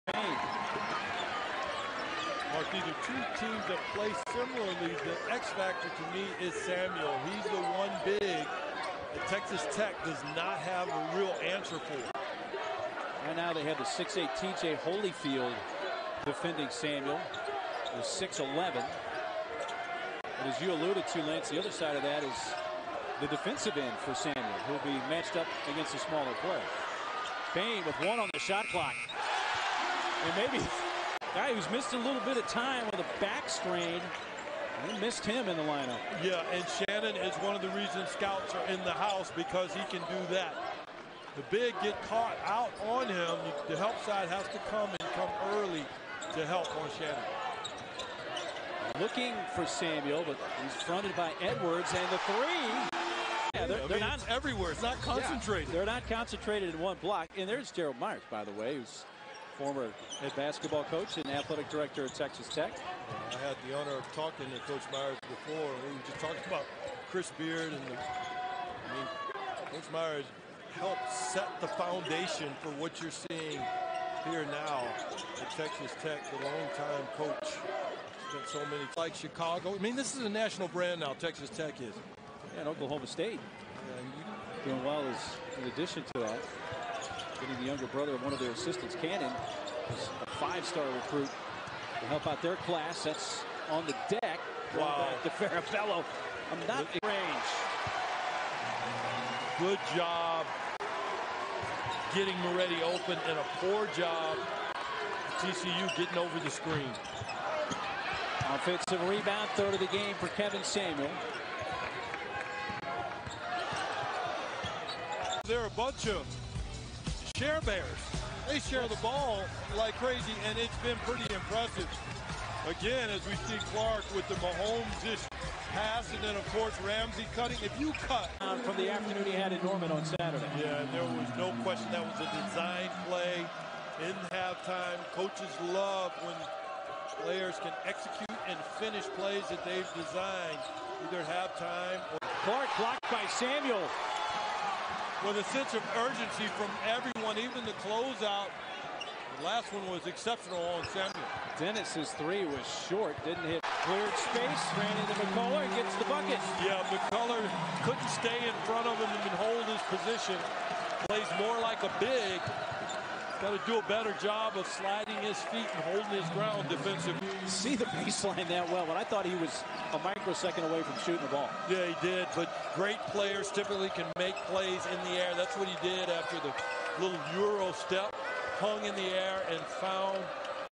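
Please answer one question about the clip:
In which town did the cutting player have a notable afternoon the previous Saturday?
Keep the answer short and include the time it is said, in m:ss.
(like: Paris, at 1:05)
Norman, at 2:09.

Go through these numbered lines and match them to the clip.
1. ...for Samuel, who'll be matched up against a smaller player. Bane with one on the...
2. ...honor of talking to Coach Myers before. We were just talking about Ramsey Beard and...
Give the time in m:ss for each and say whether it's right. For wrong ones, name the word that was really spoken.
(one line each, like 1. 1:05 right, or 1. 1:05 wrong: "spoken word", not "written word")
1. 0:23 right
2. 1:03 wrong: "Chris", not "Ramsey".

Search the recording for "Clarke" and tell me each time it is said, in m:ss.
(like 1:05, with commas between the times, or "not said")
2:03, 2:22.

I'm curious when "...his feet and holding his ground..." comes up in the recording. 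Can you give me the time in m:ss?
2:45.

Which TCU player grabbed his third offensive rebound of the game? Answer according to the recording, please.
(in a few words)
Kevin Samuel.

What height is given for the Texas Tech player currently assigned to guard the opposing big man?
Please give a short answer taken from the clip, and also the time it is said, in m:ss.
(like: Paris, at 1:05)
6'8, at 0:13.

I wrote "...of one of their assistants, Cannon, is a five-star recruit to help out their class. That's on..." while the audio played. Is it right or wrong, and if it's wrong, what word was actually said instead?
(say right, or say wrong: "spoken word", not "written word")
right.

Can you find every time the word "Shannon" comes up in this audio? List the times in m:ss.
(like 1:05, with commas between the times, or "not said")
0:36, 0:46.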